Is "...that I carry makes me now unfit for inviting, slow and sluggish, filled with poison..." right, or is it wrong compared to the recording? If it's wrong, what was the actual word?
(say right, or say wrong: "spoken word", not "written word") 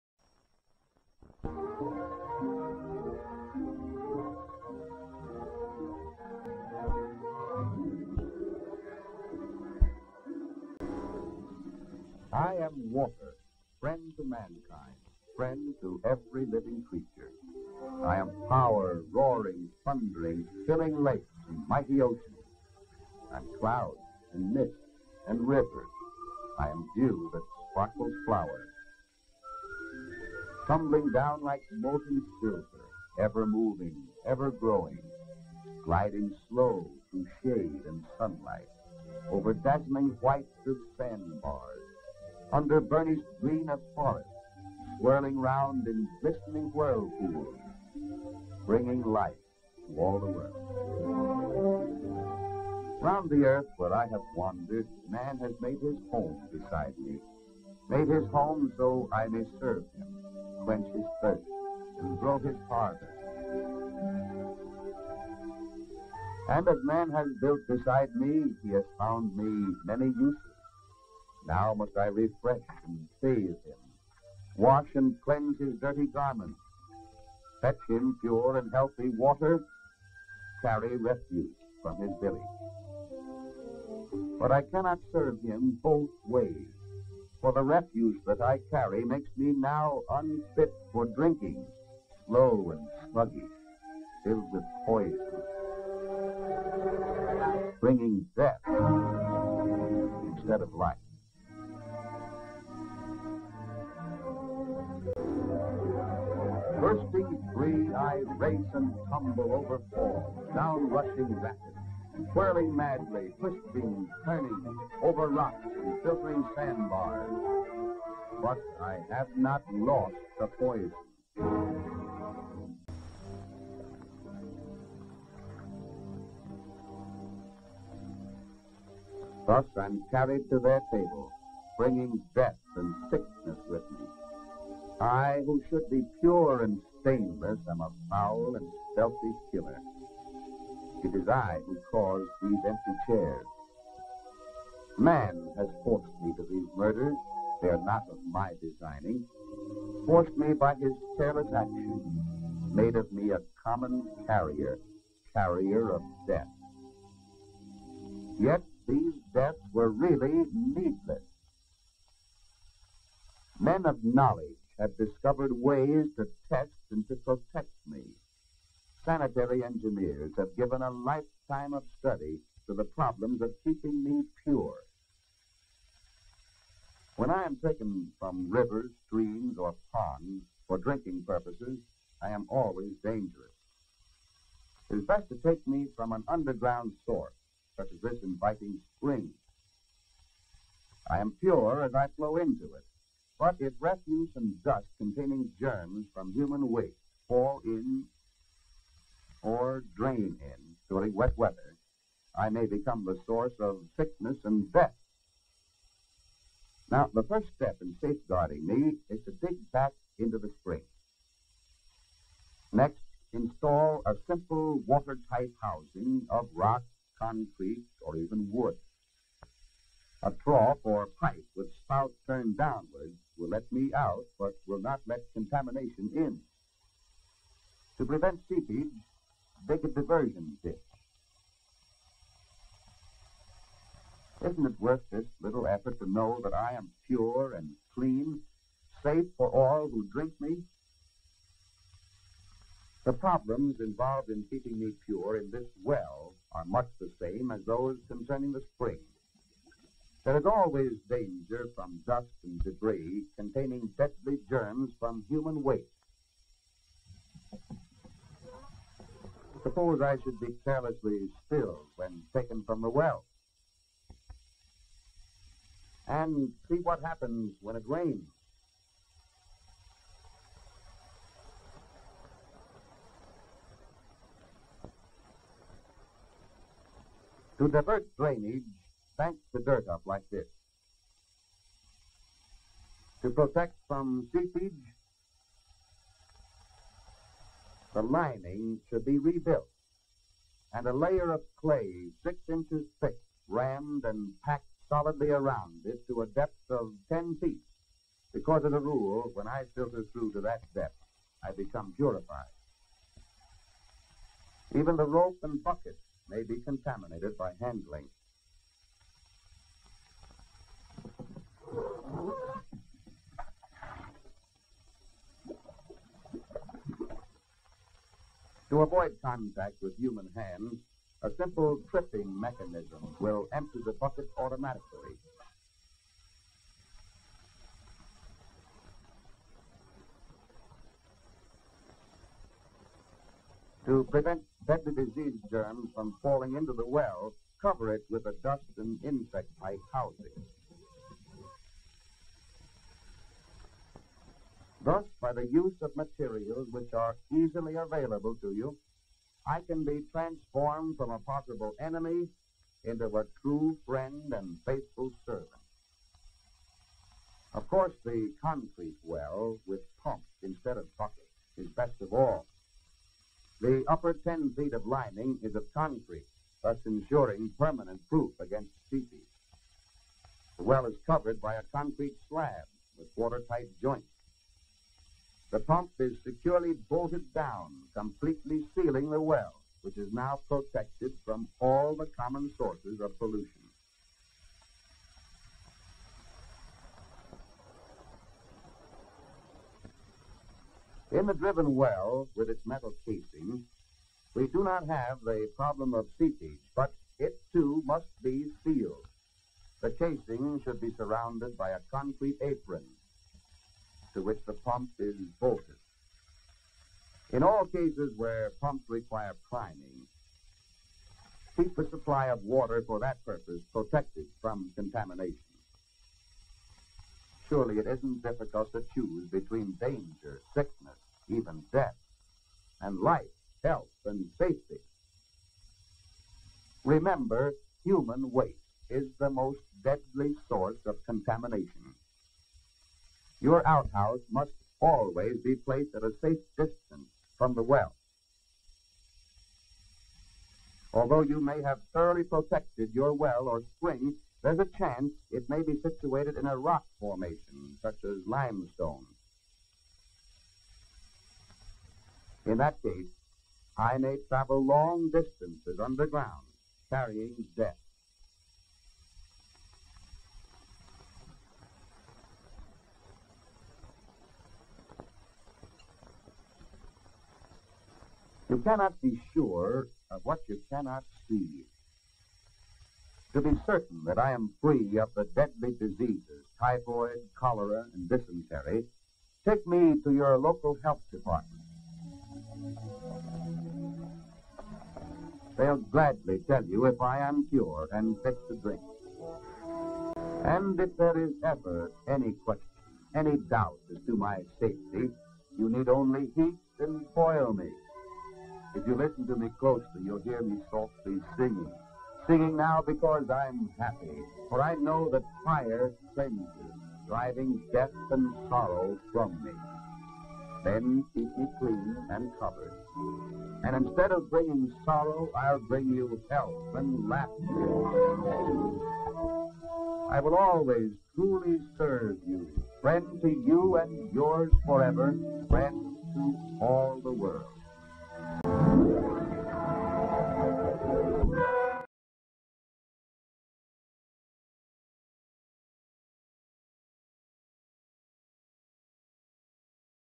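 wrong: "drinking", not "inviting".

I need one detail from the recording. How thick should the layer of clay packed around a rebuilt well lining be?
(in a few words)
6 inches.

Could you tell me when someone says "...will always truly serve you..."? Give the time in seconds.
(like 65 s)
520 s.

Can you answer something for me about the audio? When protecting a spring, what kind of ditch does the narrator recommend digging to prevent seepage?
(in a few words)
diversion ditch.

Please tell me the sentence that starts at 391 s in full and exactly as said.
In the driven well, with its metal casing, we do not have the problem of seepage, but it too must be sealed.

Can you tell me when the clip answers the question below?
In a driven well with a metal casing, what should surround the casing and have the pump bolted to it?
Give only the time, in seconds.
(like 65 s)
401 s.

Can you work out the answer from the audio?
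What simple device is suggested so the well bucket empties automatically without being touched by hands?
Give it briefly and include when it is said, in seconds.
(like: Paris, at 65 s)
tripping mechanism, at 321 s.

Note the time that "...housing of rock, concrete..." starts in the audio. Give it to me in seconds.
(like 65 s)
215 s.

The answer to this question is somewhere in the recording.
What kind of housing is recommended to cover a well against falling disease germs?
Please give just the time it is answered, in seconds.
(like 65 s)
338 s.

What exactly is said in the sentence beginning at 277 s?
To divert drainage, bank the dirt up like this.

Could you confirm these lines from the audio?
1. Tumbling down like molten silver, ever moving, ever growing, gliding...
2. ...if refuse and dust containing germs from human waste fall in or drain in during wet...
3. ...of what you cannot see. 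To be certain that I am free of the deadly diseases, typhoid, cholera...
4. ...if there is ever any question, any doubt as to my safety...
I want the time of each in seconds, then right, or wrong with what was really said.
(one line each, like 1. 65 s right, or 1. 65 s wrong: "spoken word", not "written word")
1. 30 s right
2. 193 s right
3. 470 s right
4. 490 s right.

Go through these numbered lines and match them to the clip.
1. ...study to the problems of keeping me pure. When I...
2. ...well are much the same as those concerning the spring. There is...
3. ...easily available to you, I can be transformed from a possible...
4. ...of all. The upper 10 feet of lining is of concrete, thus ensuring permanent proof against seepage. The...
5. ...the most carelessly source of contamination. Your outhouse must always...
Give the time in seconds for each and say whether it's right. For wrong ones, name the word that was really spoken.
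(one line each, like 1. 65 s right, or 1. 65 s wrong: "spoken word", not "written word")
1. 171 s right
2. 245 s right
3. 347 s right
4. 362 s right
5. 429 s wrong: "deadly", not "carelessly".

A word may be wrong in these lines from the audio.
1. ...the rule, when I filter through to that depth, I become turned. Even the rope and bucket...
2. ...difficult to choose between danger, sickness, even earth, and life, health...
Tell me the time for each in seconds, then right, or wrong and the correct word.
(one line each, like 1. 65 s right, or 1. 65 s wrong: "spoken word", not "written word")
1. 298 s wrong: "purified", not "turned"
2. 418 s wrong: "death", not "earth".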